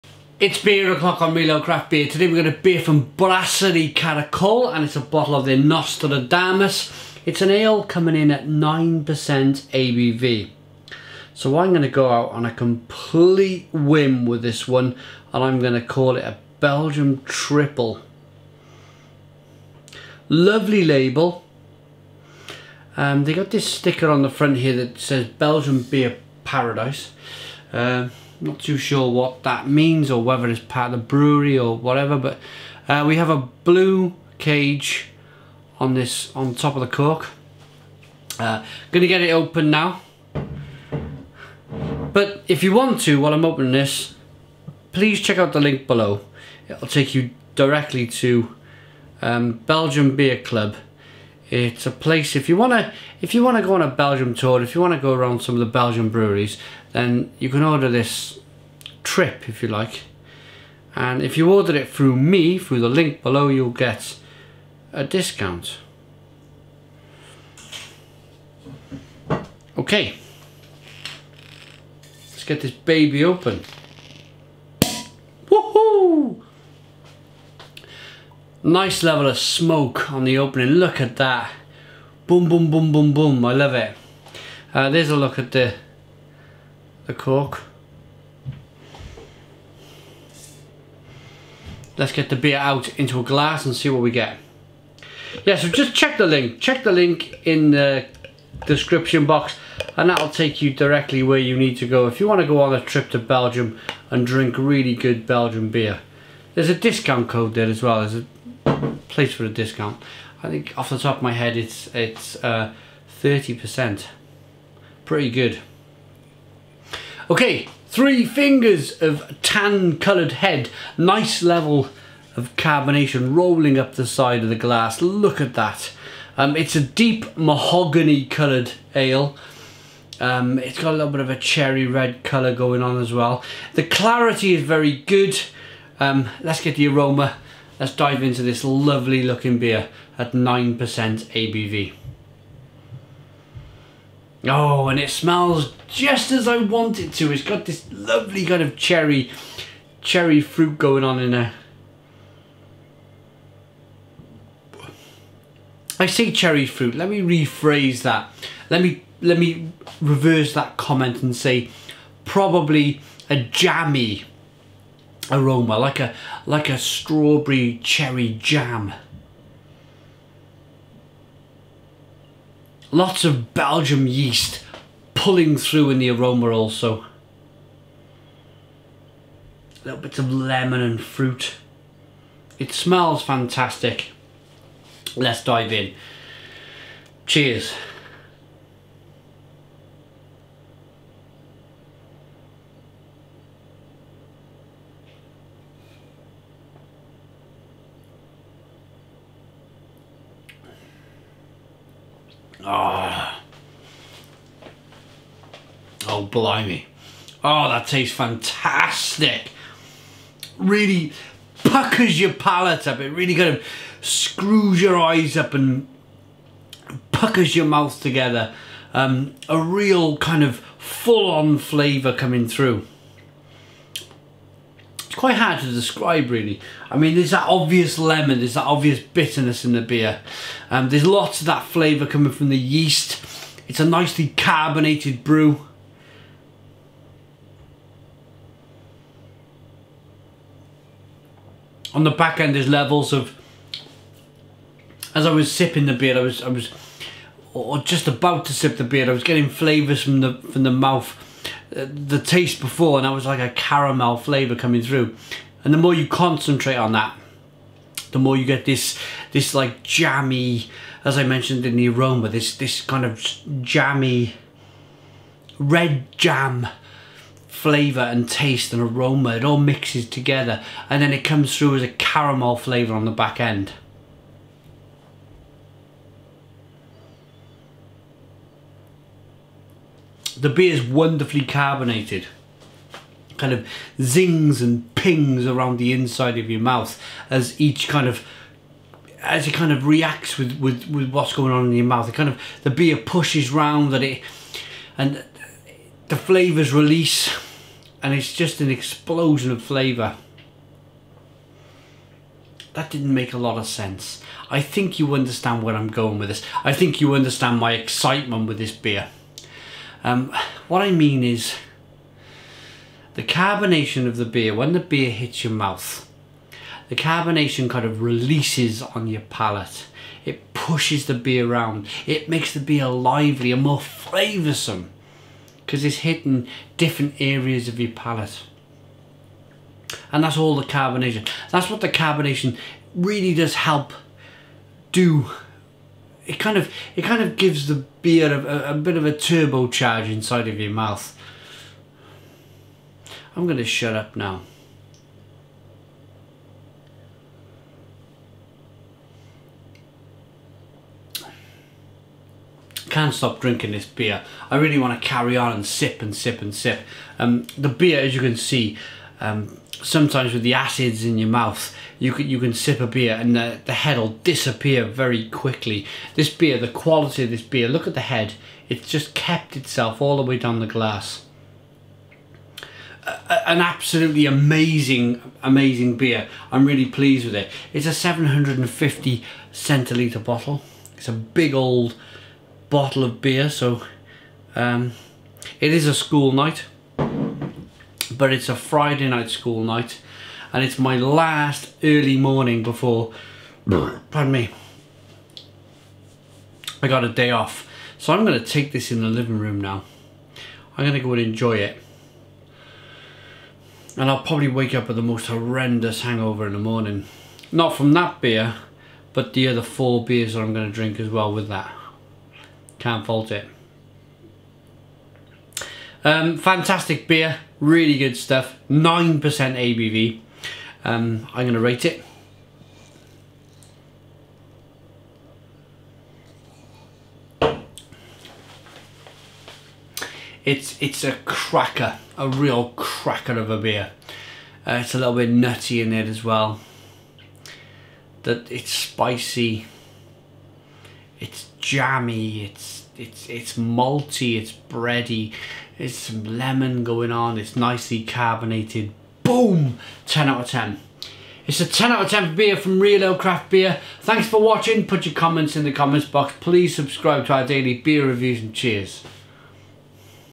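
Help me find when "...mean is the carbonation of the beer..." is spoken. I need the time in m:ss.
5:10.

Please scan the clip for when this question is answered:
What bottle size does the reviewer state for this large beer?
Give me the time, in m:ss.
6:17.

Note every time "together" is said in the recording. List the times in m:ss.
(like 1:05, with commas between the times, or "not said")
3:38, 4:30.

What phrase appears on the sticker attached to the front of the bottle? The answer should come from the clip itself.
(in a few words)
Belgium Beer Paradise.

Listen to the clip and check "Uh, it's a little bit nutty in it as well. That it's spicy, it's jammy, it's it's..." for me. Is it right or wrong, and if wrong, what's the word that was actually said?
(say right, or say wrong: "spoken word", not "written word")
right.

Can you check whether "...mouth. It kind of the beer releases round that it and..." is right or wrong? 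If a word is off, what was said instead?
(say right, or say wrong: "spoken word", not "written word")
wrong: "pushes", not "releases".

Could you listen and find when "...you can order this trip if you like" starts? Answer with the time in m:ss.
0:57.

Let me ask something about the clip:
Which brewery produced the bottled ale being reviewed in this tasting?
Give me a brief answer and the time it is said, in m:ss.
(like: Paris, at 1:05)
Brasserie Caracole, at 0:03.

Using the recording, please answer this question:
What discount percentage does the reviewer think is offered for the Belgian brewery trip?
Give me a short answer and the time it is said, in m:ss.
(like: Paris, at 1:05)
30%, at 1:52.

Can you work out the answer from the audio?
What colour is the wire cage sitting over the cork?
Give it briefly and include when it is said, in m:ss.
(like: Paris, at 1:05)
Blue, at 0:33.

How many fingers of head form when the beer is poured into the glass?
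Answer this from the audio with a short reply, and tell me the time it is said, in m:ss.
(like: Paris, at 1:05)
3, at 1:57.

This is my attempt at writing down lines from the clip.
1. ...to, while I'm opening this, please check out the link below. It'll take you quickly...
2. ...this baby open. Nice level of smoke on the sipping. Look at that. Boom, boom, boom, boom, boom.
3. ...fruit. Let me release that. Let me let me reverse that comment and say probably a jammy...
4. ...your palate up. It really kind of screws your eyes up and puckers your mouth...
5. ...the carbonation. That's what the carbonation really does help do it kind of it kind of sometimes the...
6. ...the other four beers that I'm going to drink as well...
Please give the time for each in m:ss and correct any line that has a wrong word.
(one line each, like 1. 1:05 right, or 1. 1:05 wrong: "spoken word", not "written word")
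1. 0:43 wrong: "directly", not "quickly"
2. 1:12 wrong: "opening", not "sipping"
3. 2:36 wrong: "rephrase", not "release"
4. 3:32 right
5. 5:30 wrong: "gives", not "sometimes"
6. 6:49 right.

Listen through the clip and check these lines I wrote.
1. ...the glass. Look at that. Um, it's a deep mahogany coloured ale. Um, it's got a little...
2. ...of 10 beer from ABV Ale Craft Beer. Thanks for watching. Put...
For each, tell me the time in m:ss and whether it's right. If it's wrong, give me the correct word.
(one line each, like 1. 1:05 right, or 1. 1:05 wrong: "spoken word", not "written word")
1. 2:04 right
2. 7:32 wrong: "Real", not "ABV".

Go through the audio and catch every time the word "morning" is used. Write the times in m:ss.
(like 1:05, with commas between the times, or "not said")
6:32, 6:46.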